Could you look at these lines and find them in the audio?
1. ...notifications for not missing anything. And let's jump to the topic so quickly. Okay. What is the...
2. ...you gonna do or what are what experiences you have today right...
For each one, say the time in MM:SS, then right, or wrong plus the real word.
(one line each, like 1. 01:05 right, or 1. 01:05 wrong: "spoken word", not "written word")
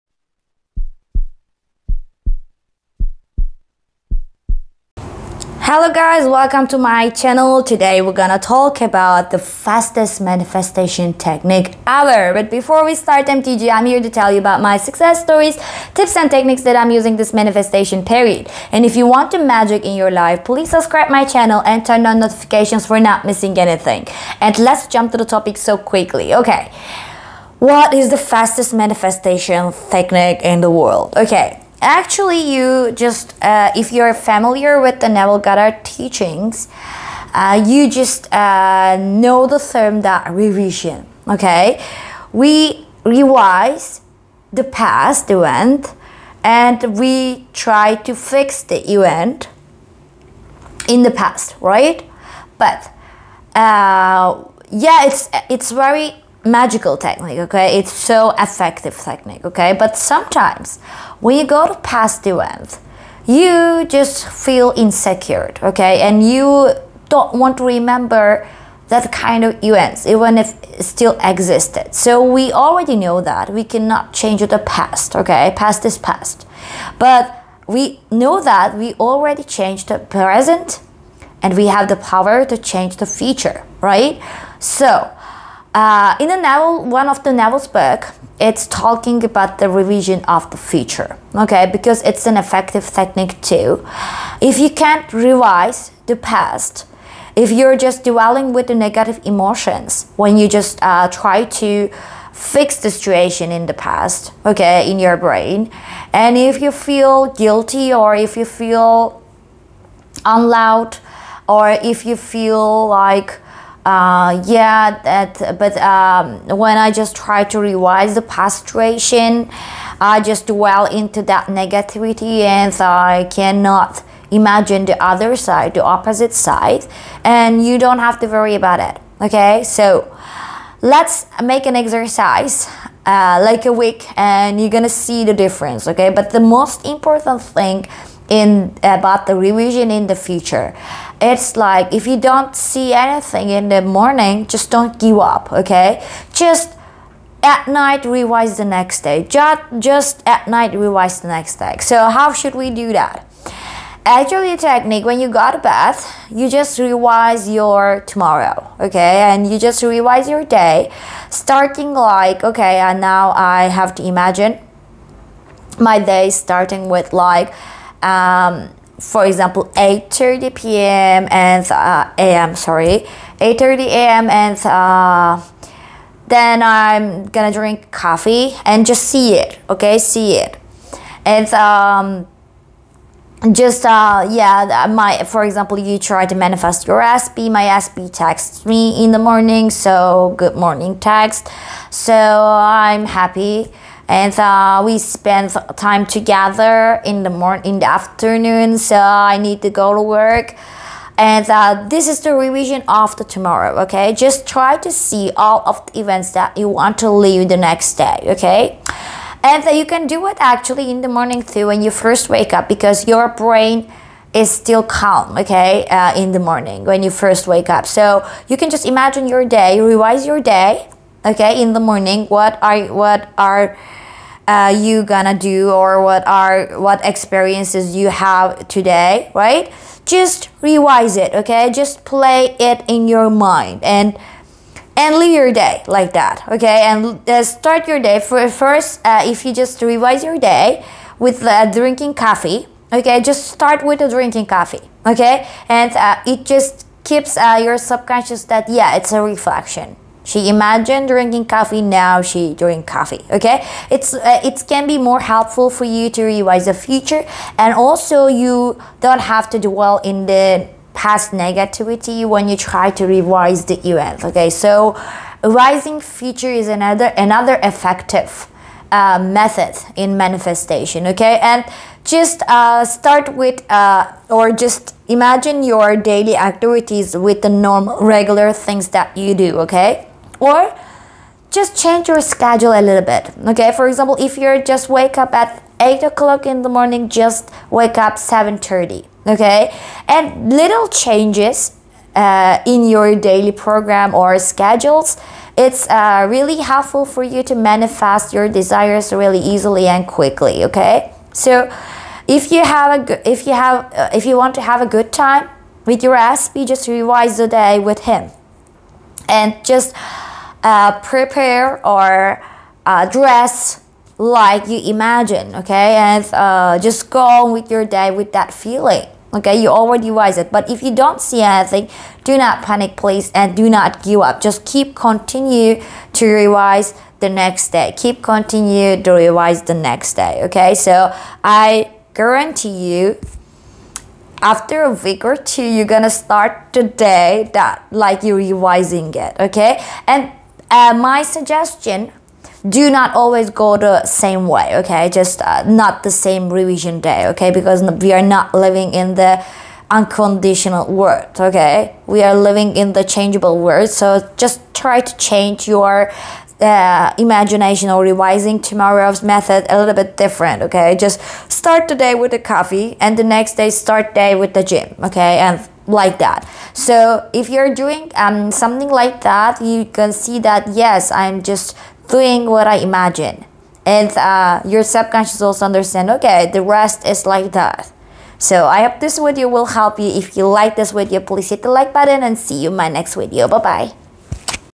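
1. 00:22 right
2. 03:44 right.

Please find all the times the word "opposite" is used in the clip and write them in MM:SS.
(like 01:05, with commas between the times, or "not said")
02:05.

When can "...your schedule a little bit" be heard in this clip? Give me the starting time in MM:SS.
04:42.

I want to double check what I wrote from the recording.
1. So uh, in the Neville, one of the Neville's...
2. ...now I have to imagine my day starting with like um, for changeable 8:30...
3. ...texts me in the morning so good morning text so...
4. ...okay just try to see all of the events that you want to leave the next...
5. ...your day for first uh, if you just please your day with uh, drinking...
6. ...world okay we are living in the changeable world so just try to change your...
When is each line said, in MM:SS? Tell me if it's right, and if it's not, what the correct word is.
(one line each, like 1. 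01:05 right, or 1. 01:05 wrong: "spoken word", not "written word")
1. 01:24 right
2. 02:42 wrong: "example", not "changeable"
3. 03:08 right
4. 03:23 right
5. 03:57 wrong: "revise", not "please"
6. 05:50 right.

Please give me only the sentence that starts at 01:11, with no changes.
So we already know that we cannot change the past, okay?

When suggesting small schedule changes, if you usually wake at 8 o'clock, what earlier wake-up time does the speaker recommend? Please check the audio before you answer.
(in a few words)
7:30.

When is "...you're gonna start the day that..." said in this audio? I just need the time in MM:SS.
05:35.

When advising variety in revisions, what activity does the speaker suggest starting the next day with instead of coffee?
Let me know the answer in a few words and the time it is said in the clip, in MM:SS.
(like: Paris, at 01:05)
The gym, at 06:04.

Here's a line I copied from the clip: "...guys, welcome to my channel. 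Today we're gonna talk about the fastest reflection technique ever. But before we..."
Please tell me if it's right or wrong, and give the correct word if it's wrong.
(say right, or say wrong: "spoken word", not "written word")
wrong: "manifestation", not "reflection".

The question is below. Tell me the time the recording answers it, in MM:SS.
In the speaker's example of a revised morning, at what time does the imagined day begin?
02:53.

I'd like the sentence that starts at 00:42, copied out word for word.
We revise the past event and we try to fix the event in the past, right?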